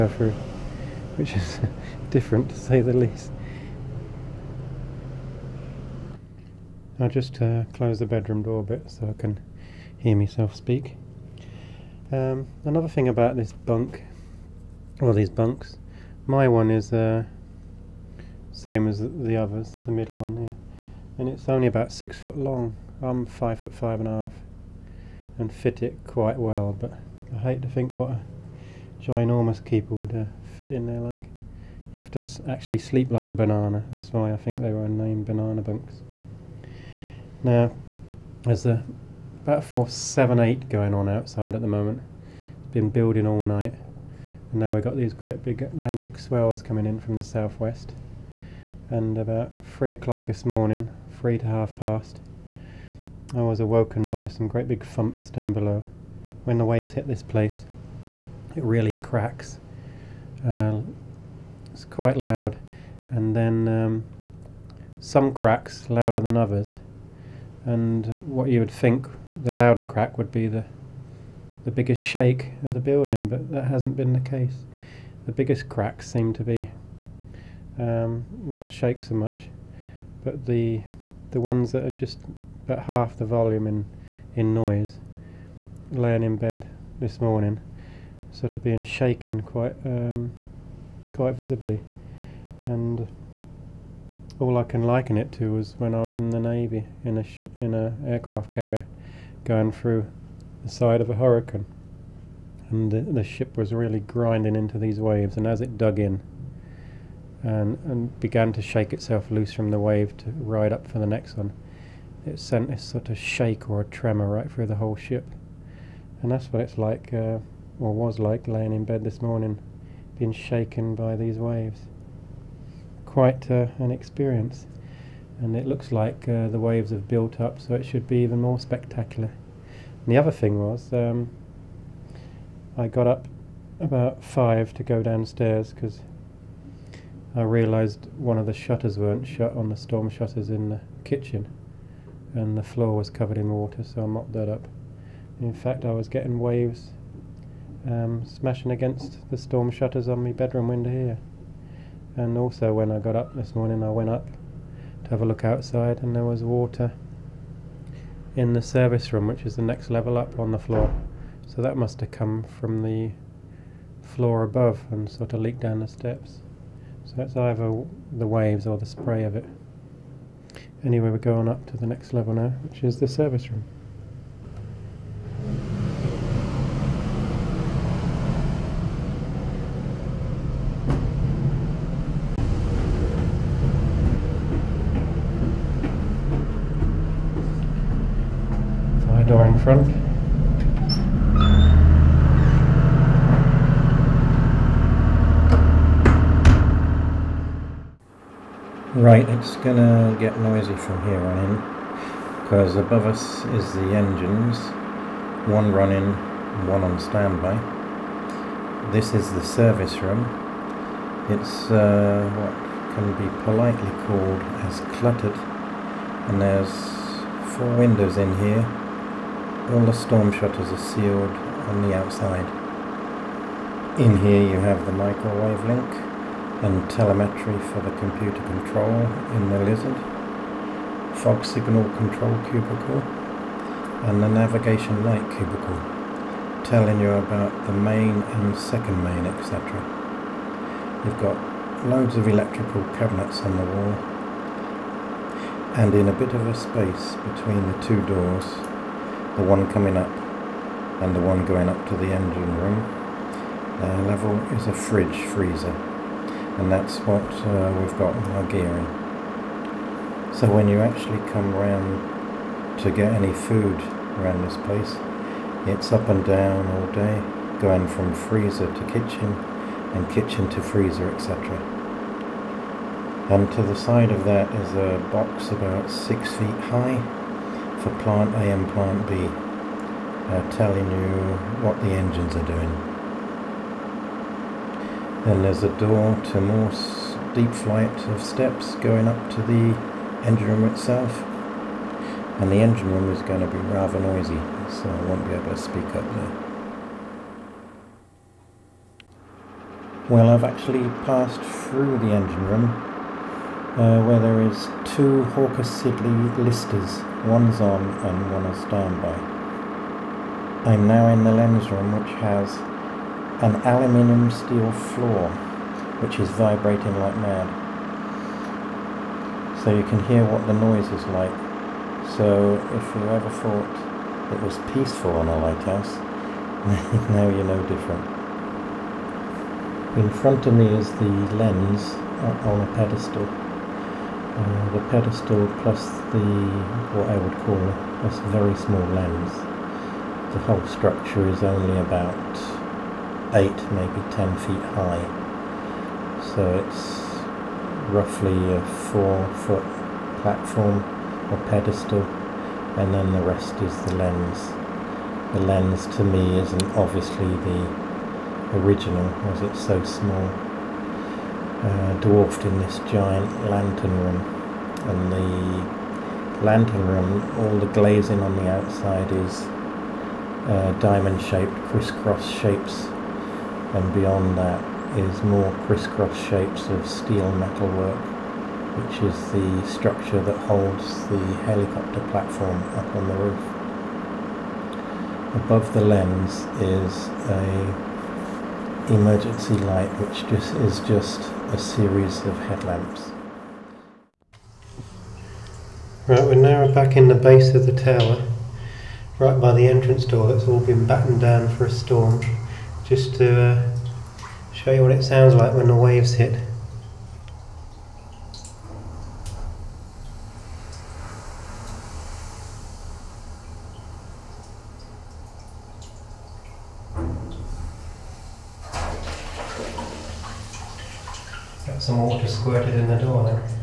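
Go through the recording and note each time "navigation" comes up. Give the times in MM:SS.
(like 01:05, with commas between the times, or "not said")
03:54.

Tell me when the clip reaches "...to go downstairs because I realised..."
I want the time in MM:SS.
02:14.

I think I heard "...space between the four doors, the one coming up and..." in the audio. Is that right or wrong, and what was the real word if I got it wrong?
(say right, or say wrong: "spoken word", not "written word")
wrong: "two", not "four".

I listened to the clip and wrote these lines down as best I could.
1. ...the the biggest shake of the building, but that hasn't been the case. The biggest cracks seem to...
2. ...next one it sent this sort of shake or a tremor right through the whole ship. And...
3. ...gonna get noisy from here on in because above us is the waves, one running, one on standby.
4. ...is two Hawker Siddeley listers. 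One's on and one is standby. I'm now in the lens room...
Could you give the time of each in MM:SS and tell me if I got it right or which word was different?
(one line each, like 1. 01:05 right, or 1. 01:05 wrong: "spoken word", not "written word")
1. 01:10 right
2. 01:51 right
3. 03:19 wrong: "engines", not "waves"
4. 05:04 right.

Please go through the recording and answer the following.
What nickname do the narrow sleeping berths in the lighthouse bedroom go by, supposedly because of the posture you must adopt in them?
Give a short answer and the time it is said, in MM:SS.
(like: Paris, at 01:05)
banana bunks, at 00:35.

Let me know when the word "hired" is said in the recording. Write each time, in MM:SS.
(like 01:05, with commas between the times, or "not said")
not said.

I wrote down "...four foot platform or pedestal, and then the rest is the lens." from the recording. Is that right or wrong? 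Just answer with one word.
right.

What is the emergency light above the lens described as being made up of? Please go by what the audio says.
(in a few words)
a series of headlamps.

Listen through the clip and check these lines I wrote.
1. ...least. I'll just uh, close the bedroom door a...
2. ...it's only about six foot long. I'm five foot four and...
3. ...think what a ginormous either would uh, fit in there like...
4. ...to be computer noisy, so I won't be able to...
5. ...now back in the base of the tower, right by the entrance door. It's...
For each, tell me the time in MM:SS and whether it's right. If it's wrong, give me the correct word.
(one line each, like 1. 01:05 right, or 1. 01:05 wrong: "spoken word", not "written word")
1. 00:02 right
2. 00:21 wrong: "five", not "four"
3. 00:27 wrong: "keeper", not "either"
4. 04:53 wrong: "rather", not "computer"
5. 06:36 right.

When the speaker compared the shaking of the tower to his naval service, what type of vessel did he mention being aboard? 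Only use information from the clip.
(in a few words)
aircraft carrier.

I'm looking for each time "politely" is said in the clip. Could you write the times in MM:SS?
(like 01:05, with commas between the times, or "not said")
03:33.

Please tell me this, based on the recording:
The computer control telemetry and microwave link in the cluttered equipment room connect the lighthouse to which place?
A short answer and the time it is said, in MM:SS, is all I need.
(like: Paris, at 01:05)
the Lizard, at 03:49.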